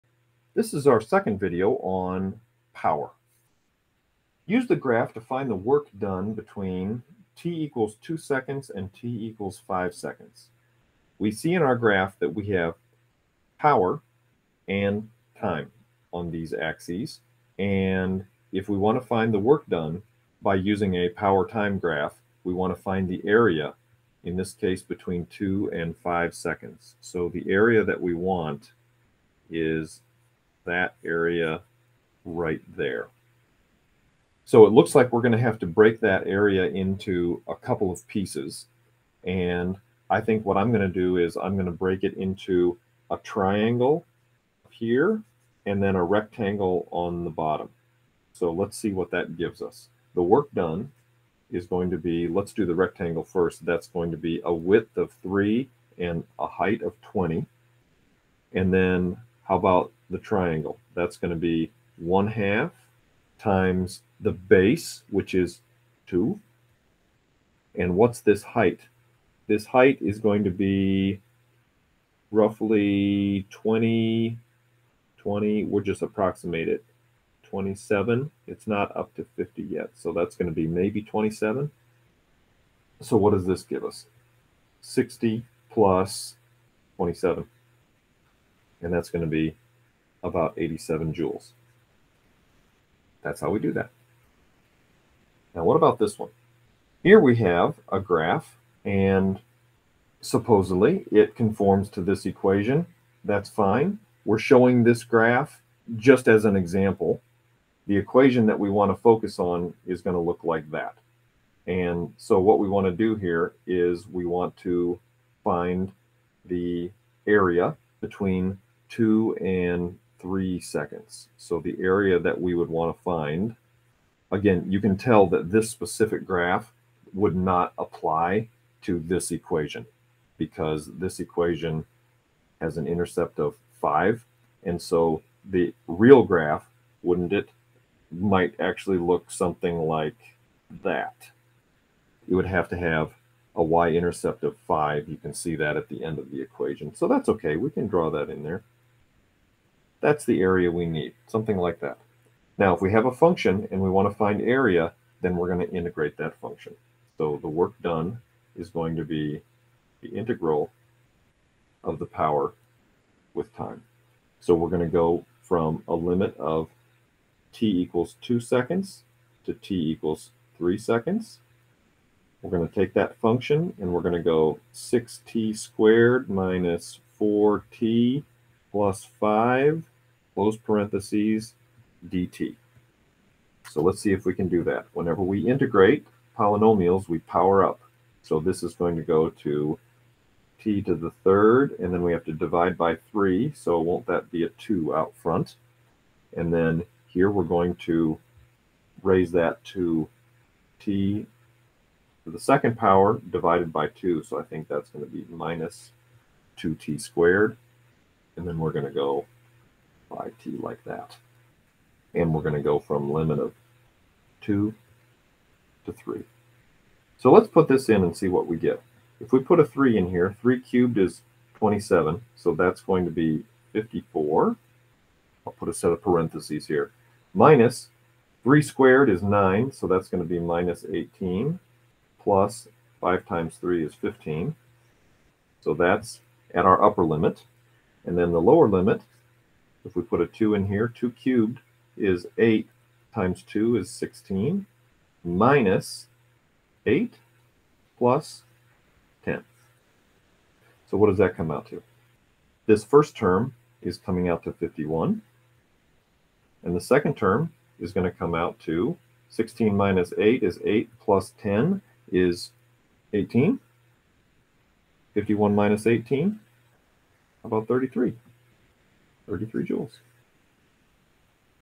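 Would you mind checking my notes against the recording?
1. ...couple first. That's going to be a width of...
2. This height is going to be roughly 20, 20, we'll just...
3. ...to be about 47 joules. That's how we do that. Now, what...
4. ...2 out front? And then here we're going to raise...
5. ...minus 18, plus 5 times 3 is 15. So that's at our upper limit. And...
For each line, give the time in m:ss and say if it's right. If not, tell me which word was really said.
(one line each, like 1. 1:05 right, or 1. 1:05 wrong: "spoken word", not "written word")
1. 0:52 wrong: "rectangle", not "couple"
2. 1:09 right
3. 1:29 wrong: "87", not "47"
4. 3:14 right
5. 3:50 right.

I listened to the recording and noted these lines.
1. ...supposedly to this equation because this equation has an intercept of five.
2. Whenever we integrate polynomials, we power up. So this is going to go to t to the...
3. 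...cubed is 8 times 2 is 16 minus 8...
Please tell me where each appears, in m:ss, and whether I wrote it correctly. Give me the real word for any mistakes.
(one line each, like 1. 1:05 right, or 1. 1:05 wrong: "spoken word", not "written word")
1. 2:07 wrong: "apply", not "supposedly"
2. 3:04 right
3. 4:01 right.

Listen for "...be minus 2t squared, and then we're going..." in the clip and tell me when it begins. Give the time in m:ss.
3:25.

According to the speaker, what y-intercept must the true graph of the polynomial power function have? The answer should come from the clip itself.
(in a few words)
5.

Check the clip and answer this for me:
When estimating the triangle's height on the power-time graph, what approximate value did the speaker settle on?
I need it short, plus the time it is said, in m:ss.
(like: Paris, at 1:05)
27, at 1:20.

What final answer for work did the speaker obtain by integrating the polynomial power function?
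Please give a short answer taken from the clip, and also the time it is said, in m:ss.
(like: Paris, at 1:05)
33 joules, at 4:29.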